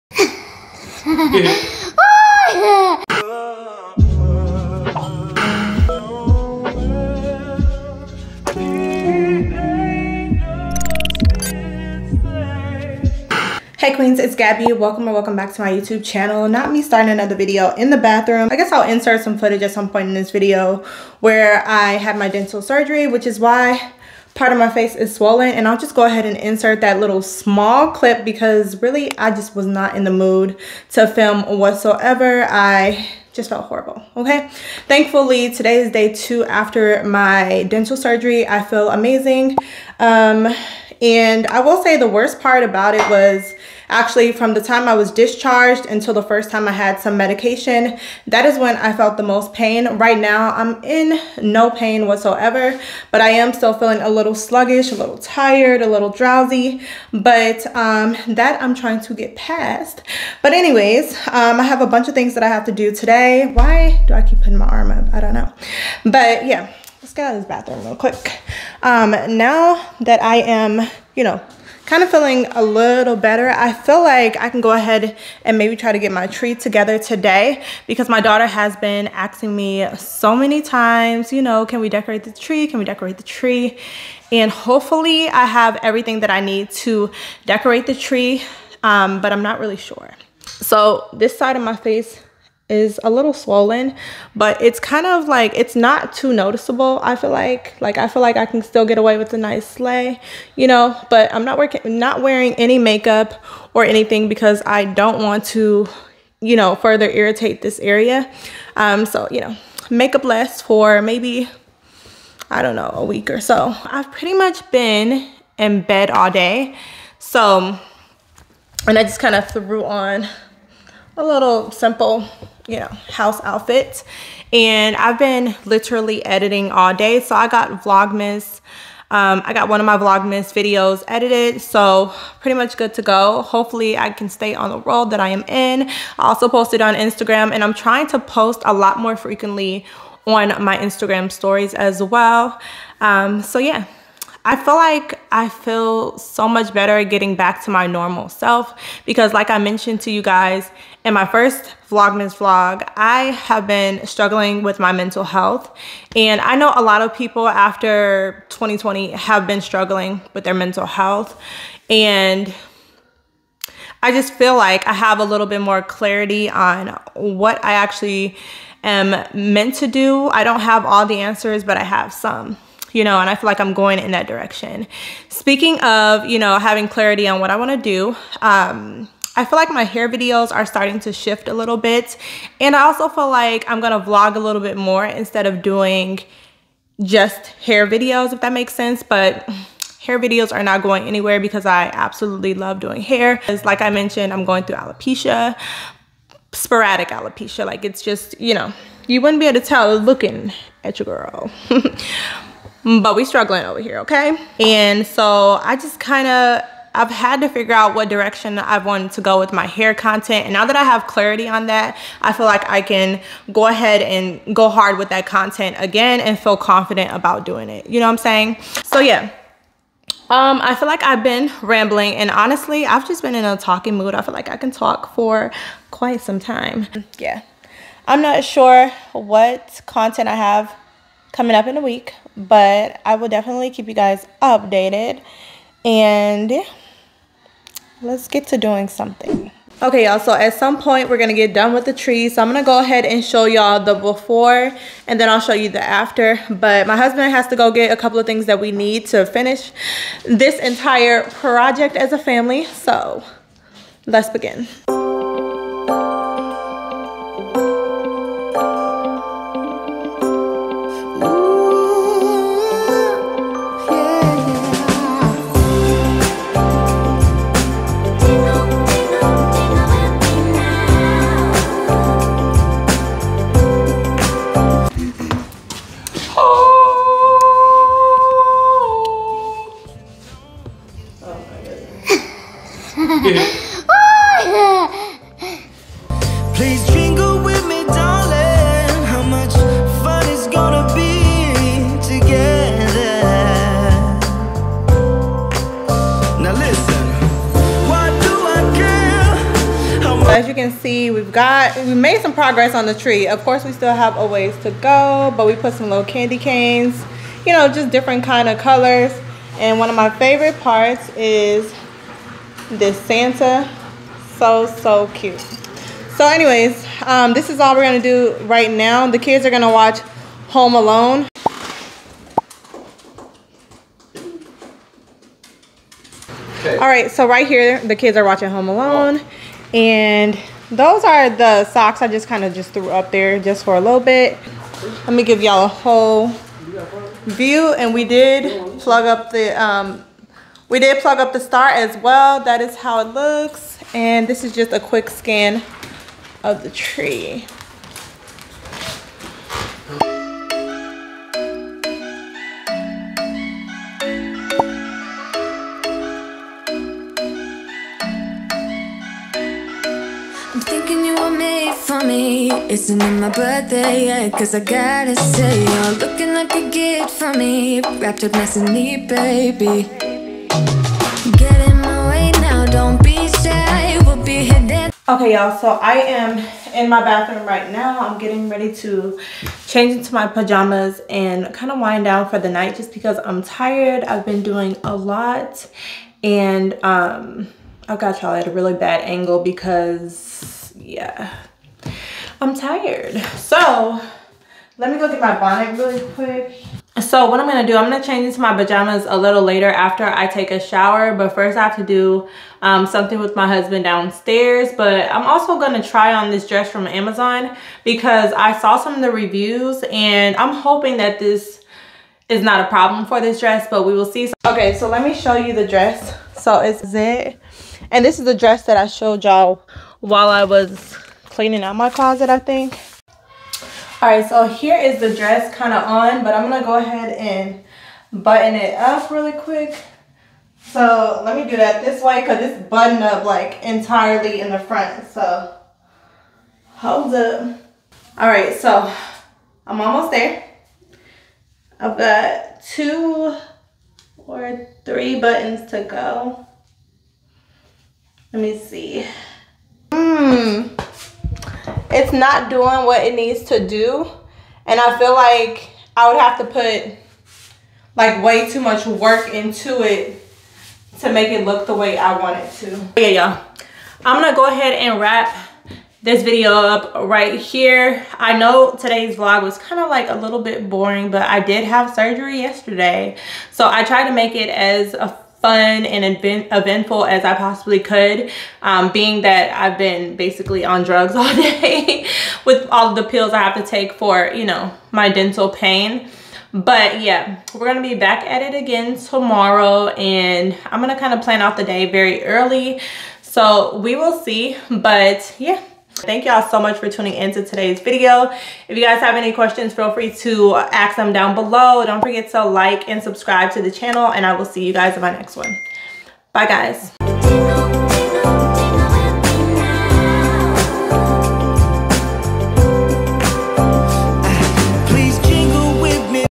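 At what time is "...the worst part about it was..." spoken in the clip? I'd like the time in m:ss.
0:41.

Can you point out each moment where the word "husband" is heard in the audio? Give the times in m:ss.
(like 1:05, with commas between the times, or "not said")
4:06, 6:43.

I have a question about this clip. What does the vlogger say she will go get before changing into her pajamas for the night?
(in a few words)
bonnet.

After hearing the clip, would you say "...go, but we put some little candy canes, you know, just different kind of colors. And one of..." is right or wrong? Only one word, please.
right.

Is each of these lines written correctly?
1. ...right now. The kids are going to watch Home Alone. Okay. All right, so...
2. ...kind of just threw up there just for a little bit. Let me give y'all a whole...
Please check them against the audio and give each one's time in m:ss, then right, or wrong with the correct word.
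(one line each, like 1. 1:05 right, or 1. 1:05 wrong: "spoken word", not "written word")
1. 5:18 right
2. 5:32 right.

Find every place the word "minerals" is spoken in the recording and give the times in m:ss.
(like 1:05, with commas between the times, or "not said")
not said.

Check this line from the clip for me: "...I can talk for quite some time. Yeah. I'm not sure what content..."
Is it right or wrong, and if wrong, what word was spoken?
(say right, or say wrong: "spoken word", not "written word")
right.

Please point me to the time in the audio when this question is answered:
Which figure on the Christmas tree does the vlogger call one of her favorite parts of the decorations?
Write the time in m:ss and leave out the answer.
5:13.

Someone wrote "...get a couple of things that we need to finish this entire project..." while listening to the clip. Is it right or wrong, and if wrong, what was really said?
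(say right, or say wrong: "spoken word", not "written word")
right.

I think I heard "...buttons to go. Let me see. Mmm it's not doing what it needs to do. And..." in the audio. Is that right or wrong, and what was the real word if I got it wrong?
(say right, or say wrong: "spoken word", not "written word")
right.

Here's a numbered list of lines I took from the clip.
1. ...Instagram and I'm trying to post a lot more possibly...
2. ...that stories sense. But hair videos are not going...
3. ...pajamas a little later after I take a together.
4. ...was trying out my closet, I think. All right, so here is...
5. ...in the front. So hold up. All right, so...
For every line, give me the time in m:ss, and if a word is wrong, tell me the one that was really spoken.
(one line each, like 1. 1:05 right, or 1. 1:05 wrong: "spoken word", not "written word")
1. 2:16 wrong: "frequently", not "possibly"
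2. 3:08 wrong: "makes", not "stories"
3. 6:38 wrong: "shower", not "together"
4. 7:00 wrong: "cleaning", not "trying"
5. 7:14 right.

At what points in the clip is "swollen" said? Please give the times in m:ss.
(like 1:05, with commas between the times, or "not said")
0:25, 1:33.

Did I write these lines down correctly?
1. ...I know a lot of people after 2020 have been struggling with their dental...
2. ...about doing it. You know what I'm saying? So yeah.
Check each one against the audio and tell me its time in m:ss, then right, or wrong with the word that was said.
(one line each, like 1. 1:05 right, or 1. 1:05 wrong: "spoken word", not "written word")
1. 2:36 wrong: "mental", not "dental"
2. 3:37 right.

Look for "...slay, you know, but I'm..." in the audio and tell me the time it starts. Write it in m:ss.
1:39.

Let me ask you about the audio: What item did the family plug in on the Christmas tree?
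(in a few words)
the star.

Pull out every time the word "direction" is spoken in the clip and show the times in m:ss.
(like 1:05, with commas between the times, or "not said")
2:54, 3:28.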